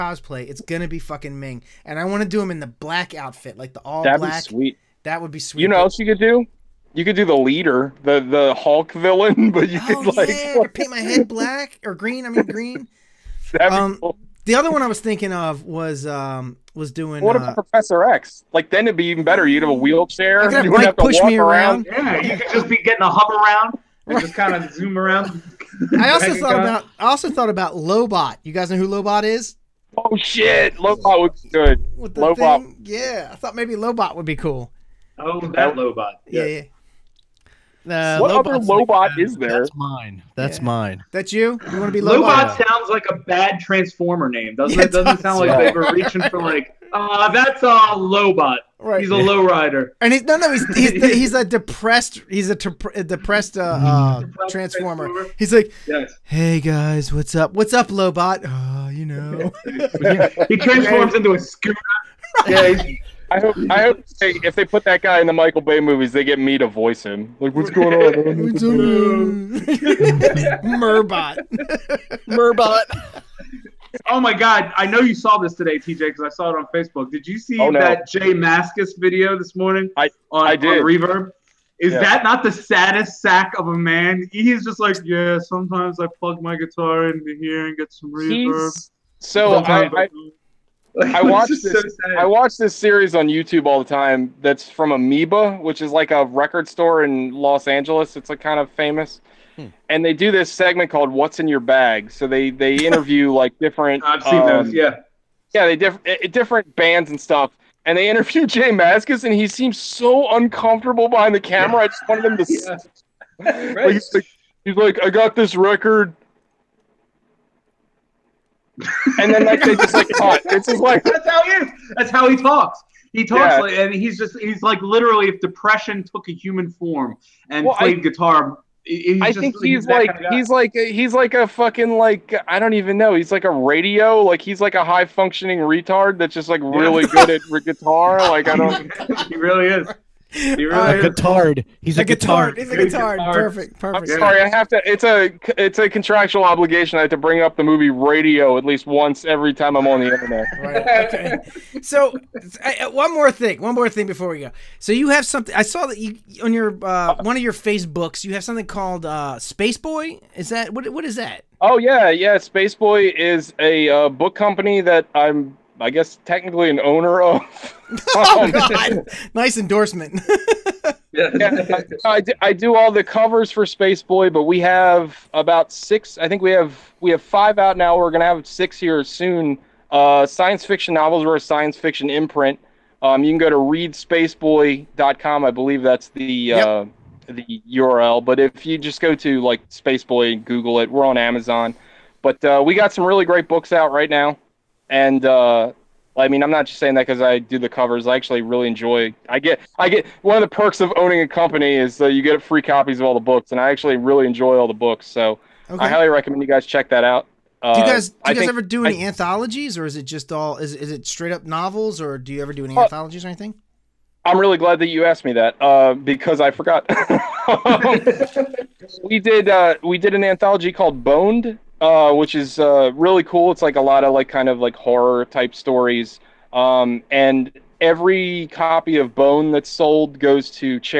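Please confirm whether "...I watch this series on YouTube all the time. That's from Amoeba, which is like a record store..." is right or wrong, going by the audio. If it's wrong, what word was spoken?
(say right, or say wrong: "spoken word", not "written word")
right.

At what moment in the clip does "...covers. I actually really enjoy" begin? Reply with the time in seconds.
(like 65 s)
197 s.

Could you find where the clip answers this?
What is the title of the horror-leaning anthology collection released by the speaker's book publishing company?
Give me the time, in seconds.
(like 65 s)
221 s.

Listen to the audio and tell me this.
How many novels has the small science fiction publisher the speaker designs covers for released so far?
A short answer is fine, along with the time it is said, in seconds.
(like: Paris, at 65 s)
5, at 177 s.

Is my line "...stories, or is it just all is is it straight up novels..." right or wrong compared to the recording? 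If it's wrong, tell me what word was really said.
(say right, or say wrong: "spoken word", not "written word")
wrong: "anthologies", not "stories".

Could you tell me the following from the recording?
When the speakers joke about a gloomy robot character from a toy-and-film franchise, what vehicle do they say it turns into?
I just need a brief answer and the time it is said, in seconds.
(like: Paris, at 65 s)
scooter, at 61 s.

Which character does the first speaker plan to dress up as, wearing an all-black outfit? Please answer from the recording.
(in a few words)
Ming.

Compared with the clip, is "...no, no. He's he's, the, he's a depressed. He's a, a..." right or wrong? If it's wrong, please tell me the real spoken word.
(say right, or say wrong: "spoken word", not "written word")
right.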